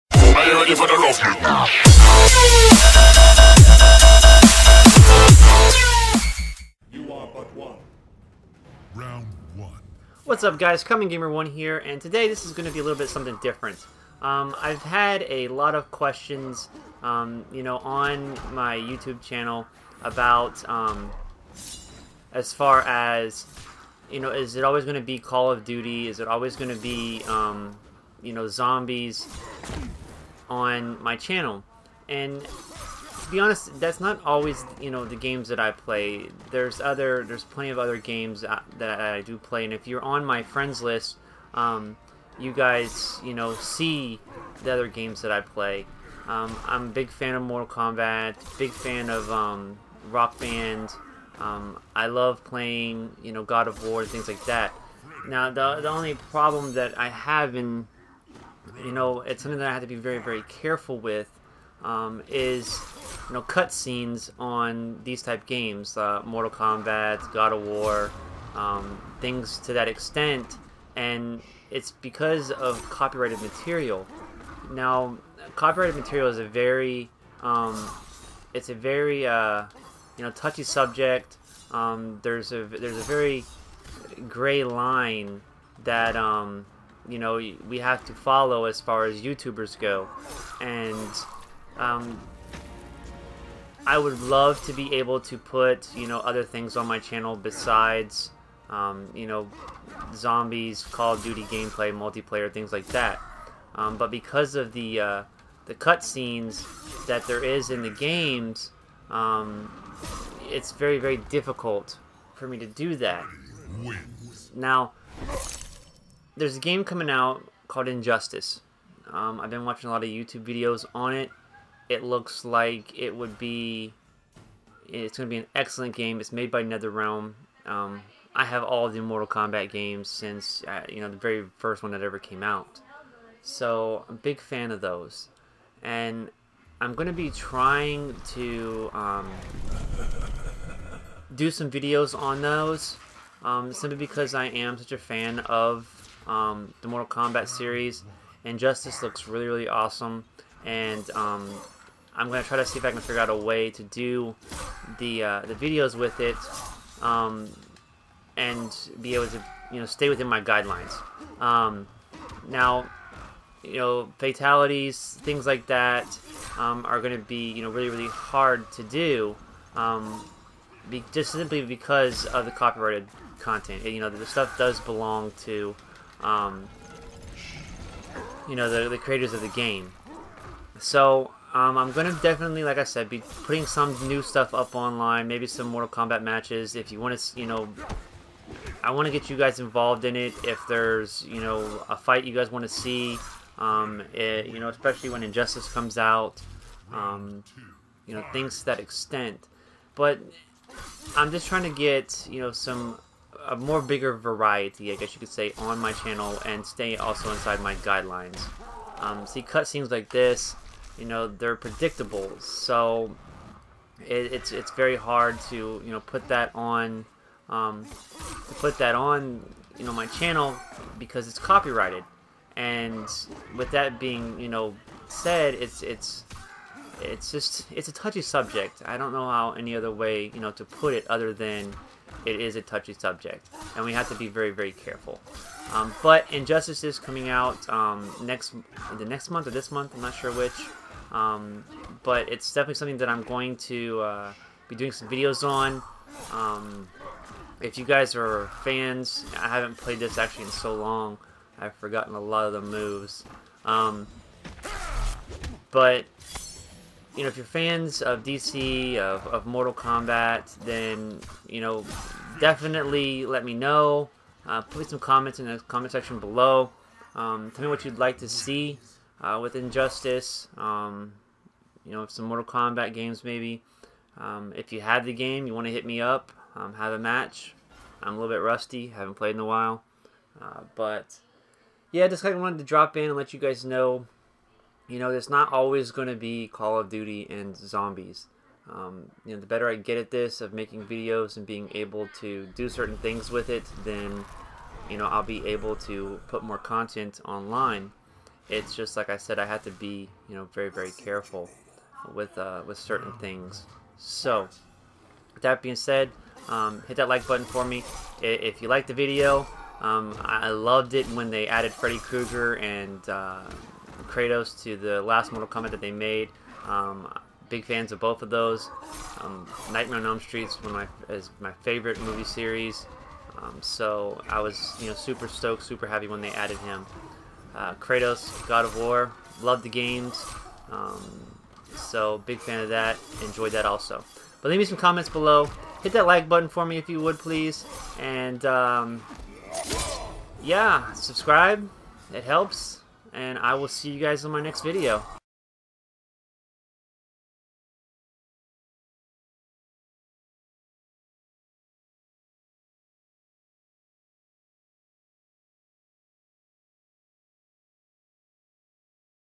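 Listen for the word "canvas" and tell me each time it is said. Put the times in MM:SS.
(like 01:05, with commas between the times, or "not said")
not said.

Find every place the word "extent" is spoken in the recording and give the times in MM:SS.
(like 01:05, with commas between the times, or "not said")
01:09, 03:18.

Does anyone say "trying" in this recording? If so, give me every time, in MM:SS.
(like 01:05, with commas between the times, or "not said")
02:17, 03:21.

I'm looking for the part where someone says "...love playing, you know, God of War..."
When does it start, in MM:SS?
00:52.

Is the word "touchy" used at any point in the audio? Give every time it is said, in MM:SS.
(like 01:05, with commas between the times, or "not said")
01:20, 03:47, 03:52.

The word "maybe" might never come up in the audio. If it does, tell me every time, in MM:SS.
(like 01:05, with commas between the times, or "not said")
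03:05, 04:33.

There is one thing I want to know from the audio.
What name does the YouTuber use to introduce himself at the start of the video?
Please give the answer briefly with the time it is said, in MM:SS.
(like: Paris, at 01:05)
Common Gamer One, at 00:10.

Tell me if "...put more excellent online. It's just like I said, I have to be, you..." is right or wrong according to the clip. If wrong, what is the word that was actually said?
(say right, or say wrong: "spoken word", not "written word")
wrong: "content", not "excellent".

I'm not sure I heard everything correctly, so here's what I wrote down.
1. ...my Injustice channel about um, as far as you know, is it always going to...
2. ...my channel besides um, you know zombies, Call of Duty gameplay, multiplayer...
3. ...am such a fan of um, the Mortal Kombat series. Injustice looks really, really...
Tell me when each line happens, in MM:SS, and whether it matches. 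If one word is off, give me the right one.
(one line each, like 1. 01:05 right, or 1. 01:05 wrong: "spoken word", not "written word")
1. 00:18 wrong: "YouTube", not "Injustice"
2. 01:36 right
3. 02:24 right.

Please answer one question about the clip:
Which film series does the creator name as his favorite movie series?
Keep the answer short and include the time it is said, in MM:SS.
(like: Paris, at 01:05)
Nightmare on Elm Street, at 05:19.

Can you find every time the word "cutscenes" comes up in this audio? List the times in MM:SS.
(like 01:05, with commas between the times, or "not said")
01:03, 01:45, 03:29.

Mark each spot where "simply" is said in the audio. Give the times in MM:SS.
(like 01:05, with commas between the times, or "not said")
02:23, 02:51.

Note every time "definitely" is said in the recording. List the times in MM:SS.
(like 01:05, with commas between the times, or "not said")
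03:02, 04:02, 04:22.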